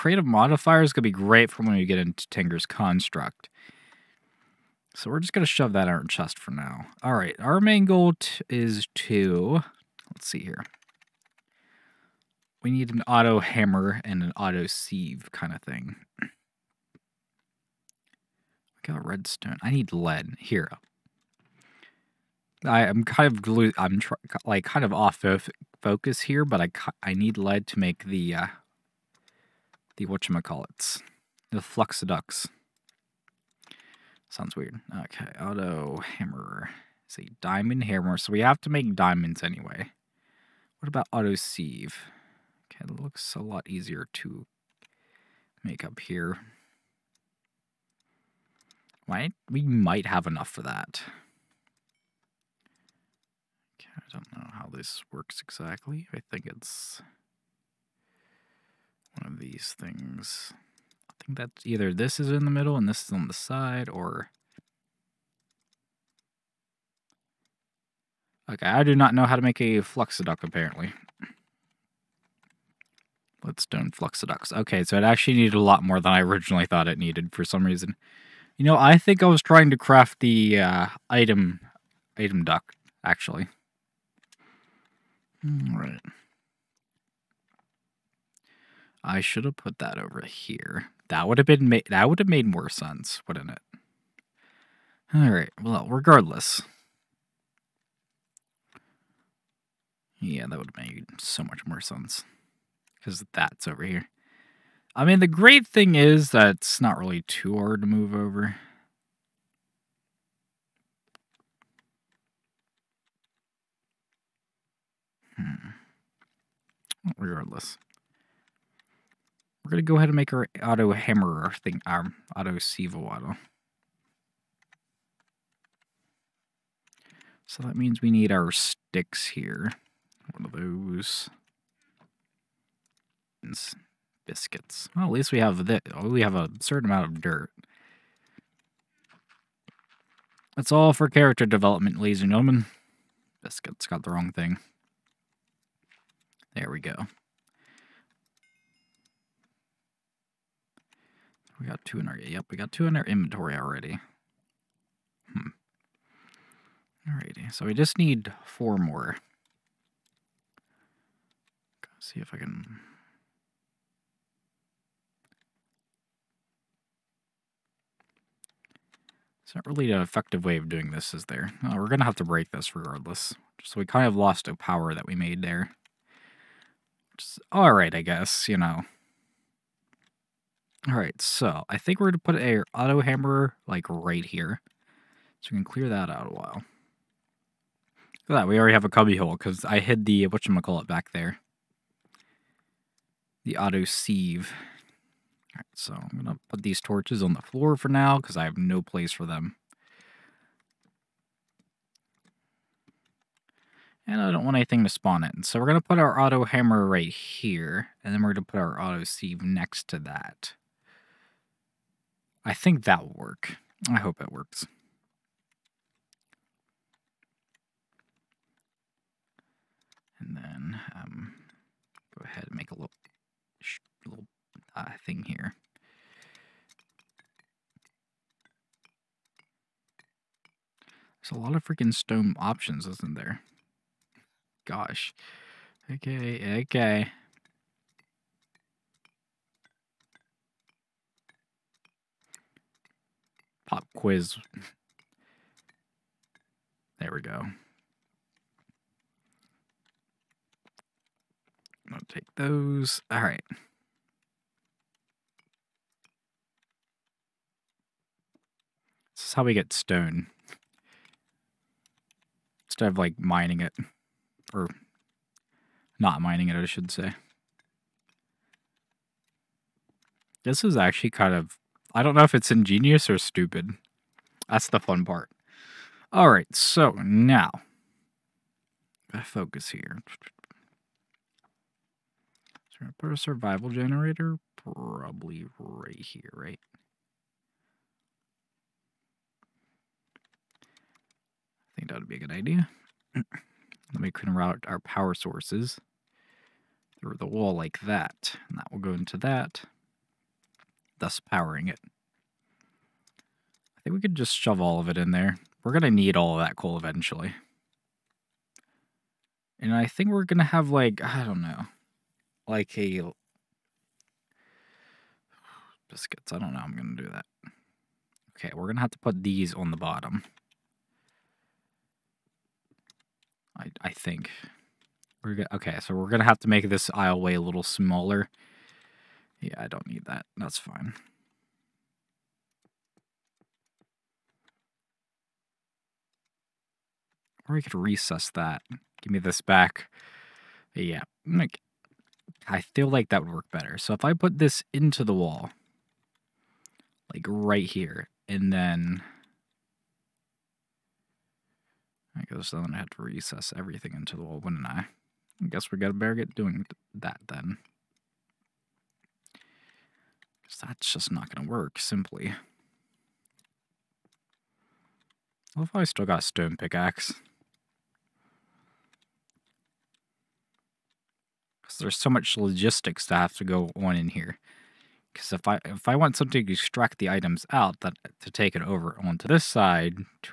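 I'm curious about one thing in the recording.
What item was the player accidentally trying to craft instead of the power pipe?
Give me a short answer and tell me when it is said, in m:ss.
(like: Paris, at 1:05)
Item duct, at 1:22.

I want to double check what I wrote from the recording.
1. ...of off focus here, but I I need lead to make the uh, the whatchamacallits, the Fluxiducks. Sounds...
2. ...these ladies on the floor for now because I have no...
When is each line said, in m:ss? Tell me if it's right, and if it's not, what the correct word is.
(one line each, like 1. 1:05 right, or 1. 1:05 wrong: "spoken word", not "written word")
1. 0:24 right
2. 3:16 wrong: "torches", not "ladies".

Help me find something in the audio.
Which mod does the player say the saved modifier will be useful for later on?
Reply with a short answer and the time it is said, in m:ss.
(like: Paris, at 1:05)
Tinker's Construct, at 0:02.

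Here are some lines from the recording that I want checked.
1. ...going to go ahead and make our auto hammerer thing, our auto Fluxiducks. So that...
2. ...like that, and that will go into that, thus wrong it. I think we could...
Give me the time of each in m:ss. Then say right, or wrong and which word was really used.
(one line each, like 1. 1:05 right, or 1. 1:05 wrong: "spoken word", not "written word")
1. 1:59 wrong: "Sivowaddle", not "Fluxiducks"
2. 4:57 wrong: "powering", not "wrong".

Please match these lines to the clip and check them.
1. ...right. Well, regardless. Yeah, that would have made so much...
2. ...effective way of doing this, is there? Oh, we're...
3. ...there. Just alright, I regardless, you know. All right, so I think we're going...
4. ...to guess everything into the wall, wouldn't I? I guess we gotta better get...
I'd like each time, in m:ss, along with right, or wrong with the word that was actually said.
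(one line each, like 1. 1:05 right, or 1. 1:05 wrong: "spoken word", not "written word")
1. 1:35 right
2. 2:50 right
3. 2:55 wrong: "guess", not "regardless"
4. 5:52 wrong: "recess", not "guess".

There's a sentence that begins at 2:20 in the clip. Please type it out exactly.
That's all for character development, ladies and gentlemen.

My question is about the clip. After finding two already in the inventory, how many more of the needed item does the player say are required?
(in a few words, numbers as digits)
4.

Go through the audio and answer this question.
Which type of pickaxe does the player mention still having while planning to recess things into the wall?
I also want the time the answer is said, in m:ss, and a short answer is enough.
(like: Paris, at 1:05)
Stone pickaxe, at 6:06.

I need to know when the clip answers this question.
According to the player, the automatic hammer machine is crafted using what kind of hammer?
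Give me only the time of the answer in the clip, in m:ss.
0:37.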